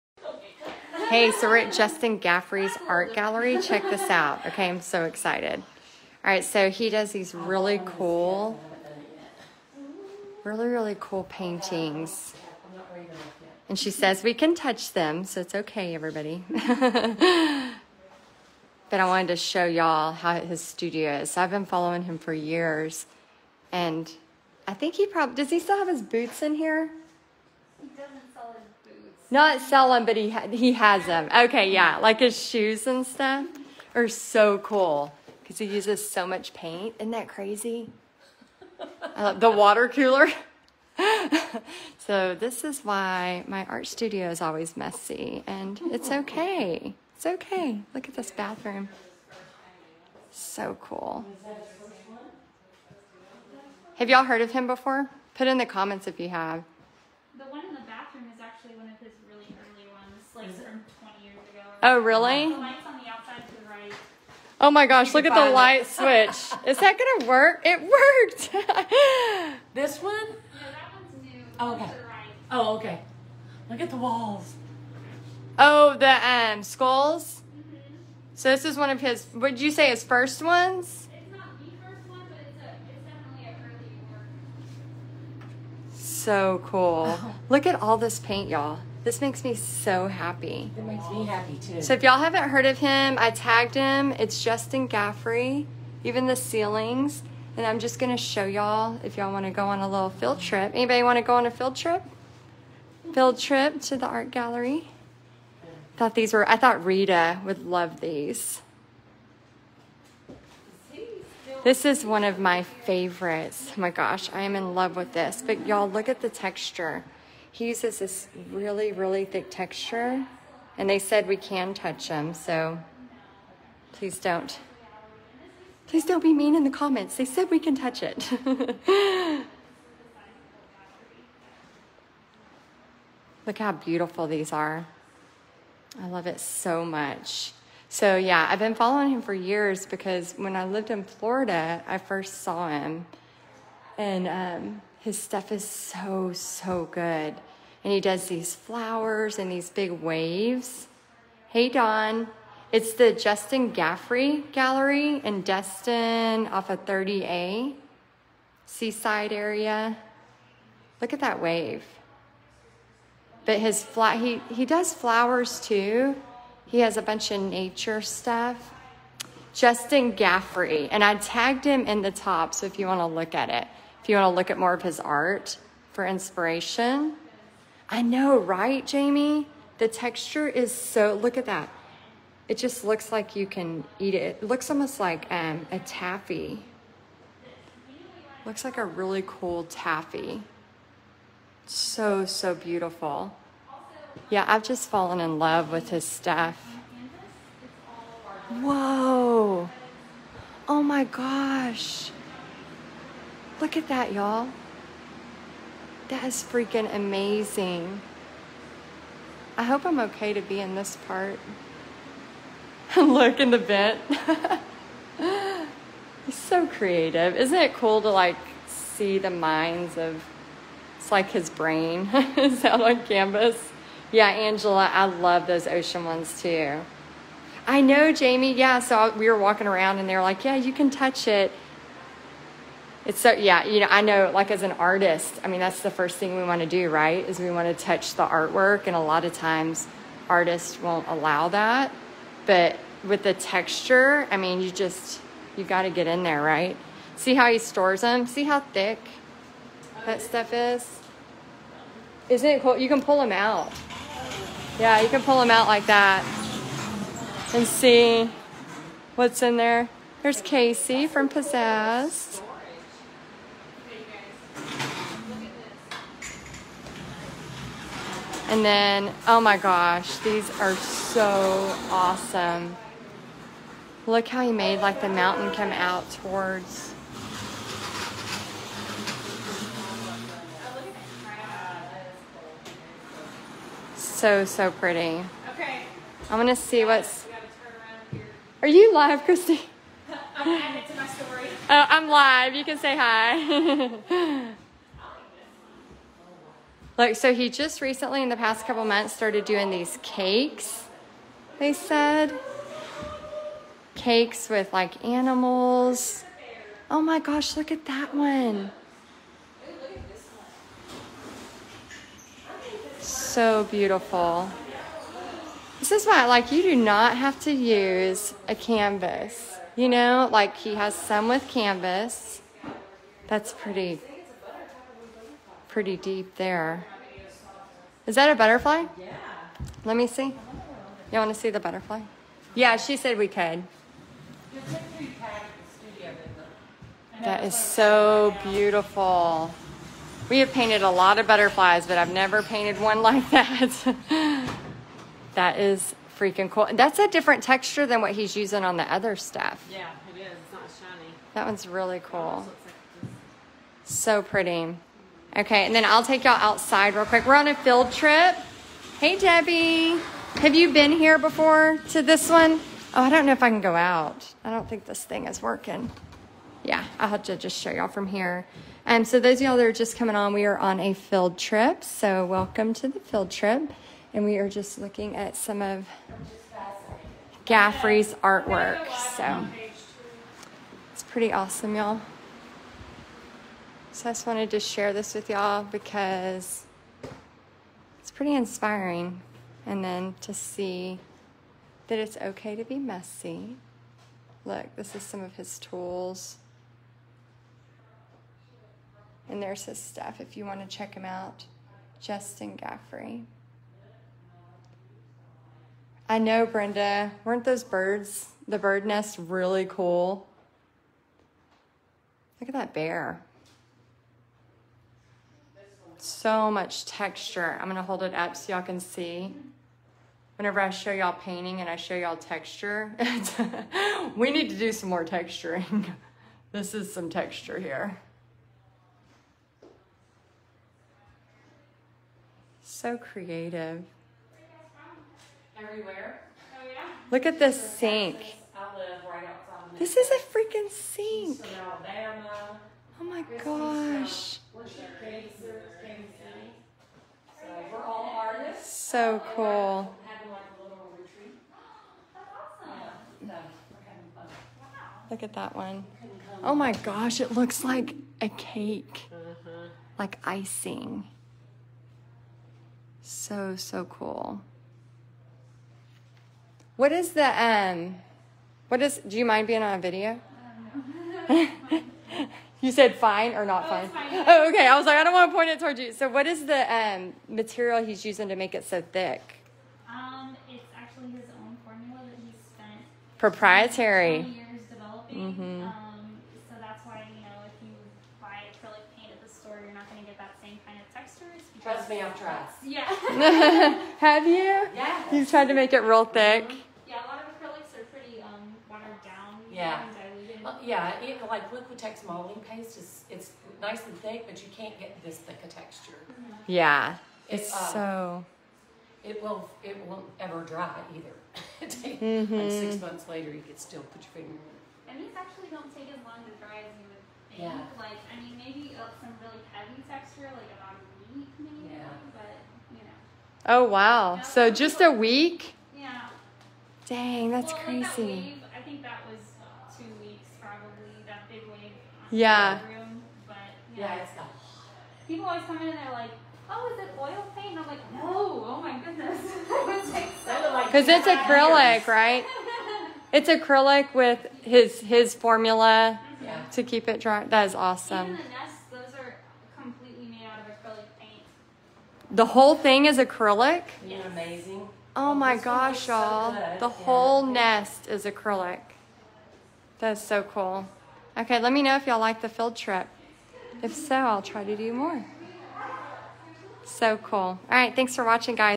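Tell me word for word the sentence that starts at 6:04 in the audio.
I don't think this thing is working.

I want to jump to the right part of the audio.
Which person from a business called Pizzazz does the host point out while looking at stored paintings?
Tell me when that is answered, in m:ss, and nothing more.
4:20.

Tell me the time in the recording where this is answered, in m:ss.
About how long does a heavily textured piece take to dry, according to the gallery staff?
8:40.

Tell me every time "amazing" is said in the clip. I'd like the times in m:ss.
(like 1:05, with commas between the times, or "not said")
3:26, 9:14.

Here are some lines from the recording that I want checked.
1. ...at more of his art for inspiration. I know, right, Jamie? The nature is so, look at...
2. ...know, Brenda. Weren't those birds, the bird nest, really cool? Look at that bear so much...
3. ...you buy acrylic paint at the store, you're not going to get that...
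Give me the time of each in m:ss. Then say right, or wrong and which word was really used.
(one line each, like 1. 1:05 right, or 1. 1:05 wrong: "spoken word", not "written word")
1. 2:54 wrong: "texture", not "nature"
2. 6:46 right
3. 8:07 right.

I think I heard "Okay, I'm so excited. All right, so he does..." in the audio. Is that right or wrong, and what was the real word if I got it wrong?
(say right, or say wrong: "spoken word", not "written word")
right.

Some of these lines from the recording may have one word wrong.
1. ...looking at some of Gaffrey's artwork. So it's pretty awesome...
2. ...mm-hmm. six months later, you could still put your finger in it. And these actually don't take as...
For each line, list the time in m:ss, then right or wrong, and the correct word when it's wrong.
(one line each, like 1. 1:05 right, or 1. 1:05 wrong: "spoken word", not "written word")
1. 6:14 right
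2. 8:32 right.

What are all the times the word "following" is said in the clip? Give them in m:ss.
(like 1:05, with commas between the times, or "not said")
0:21, 2:18.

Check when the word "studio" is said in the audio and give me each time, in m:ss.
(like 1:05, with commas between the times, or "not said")
0:20, 0:43.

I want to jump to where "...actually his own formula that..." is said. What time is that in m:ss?
8:00.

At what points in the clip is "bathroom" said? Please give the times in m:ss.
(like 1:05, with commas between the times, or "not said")
0:48.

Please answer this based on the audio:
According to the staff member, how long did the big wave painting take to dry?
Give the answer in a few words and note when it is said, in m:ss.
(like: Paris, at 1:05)
2 weeks, at 8:49.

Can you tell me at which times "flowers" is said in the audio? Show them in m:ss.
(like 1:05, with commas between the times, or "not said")
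2:28, 2:44.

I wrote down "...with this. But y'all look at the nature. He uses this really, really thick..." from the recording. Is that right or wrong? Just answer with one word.
wrong.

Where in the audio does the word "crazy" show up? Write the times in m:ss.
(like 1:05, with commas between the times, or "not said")
0:37, 8:47.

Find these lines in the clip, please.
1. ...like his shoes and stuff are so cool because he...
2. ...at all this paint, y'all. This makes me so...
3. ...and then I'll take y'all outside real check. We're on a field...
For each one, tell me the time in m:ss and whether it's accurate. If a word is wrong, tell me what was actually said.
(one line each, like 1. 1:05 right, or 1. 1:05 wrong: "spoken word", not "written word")
1. 0:31 right
2. 1:27 right
3. 5:55 wrong: "quick", not "check".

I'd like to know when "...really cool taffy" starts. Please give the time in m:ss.
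3:08.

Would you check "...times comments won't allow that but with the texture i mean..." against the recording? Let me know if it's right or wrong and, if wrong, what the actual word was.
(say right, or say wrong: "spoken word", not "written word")
wrong: "artists", not "comments".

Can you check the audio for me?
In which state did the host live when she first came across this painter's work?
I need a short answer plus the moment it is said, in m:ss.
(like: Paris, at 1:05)
Florida, at 2:21.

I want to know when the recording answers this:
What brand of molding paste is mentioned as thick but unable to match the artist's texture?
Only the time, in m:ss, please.
8:21.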